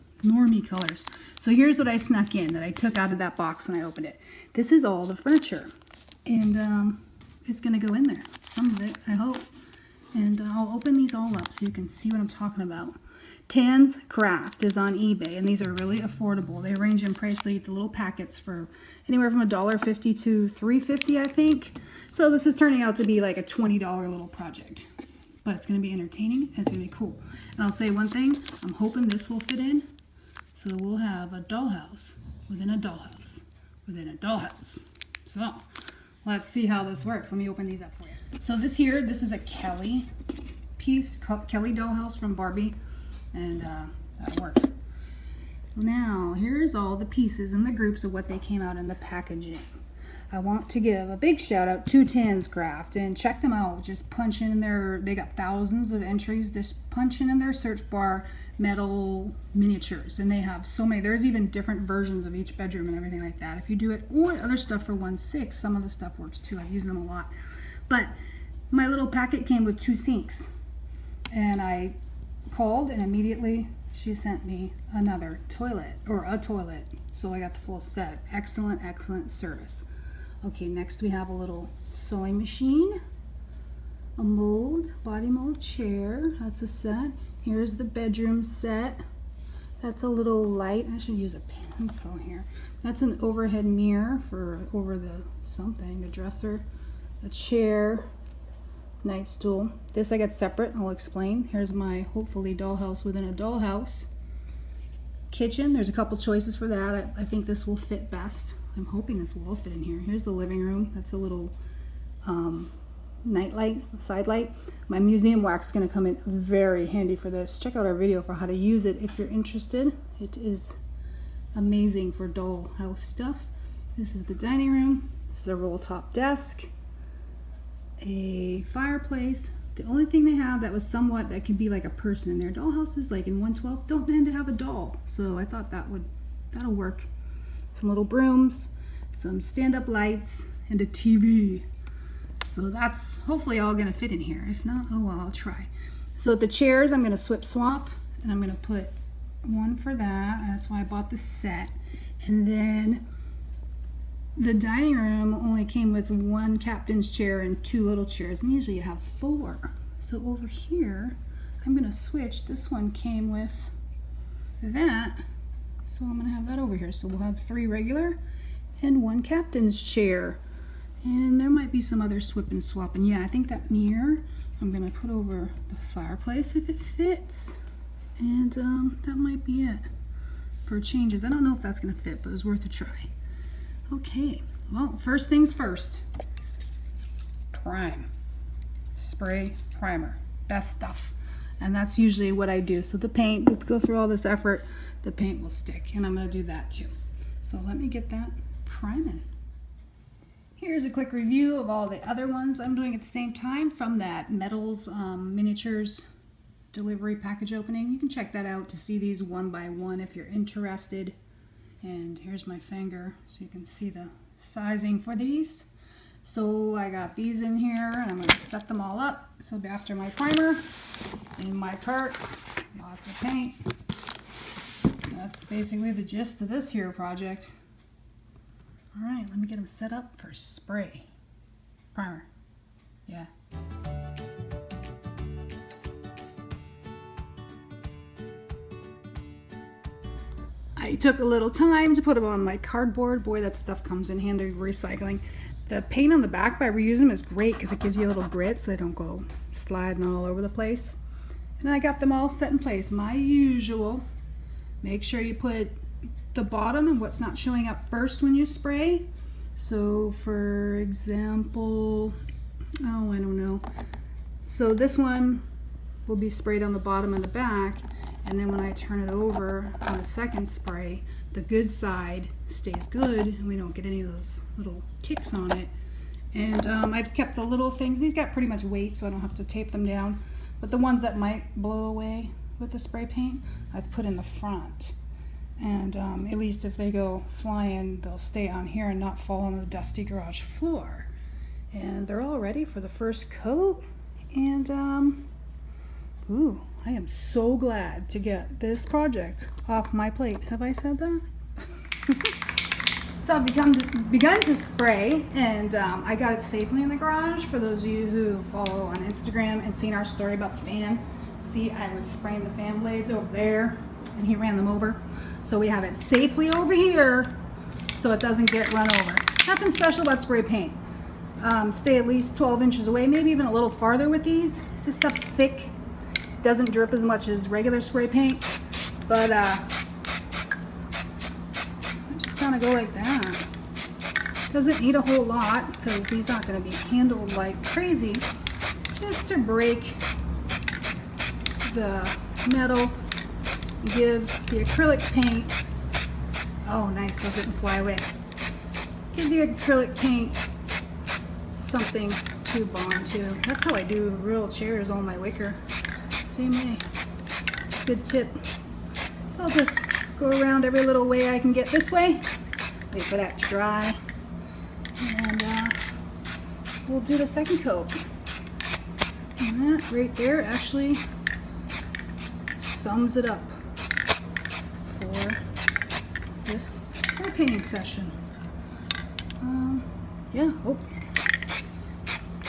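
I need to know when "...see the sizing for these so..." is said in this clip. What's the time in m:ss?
3:33.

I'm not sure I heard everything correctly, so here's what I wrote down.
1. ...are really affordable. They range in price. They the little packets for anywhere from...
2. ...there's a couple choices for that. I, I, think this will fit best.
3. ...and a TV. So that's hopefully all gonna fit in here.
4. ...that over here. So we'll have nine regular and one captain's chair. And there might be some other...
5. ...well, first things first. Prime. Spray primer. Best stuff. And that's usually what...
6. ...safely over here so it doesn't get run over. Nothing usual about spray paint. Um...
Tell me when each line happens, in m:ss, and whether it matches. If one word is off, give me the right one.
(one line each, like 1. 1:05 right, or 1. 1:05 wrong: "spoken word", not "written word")
1. 0:15 right
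2. 1:45 right
3. 2:20 right
4. 2:46 wrong: "three", not "nine"
5. 3:04 right
6. 5:15 wrong: "special", not "usual".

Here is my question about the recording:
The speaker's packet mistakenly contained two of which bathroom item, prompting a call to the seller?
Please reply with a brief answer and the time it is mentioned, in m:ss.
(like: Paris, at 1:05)
sinks, at 1:09.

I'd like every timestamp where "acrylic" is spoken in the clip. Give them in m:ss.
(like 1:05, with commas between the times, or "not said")
5:44, 5:49.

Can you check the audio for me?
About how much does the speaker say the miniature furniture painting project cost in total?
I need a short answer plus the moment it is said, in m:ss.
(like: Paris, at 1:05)
$20, at 0:23.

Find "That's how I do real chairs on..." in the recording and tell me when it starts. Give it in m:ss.
5:53.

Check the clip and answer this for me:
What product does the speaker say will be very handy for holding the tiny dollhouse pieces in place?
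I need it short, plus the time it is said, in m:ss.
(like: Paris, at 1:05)
museum wax, at 1:54.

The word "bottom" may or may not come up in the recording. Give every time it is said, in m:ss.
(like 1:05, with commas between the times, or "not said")
4:16, 4:26.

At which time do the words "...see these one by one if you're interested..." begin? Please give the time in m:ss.
3:28.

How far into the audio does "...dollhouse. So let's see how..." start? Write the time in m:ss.
0:34.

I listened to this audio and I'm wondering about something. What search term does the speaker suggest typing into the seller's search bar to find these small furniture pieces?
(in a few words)
metal miniatures.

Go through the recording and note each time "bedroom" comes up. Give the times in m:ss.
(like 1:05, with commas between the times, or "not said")
1:02, 1:27.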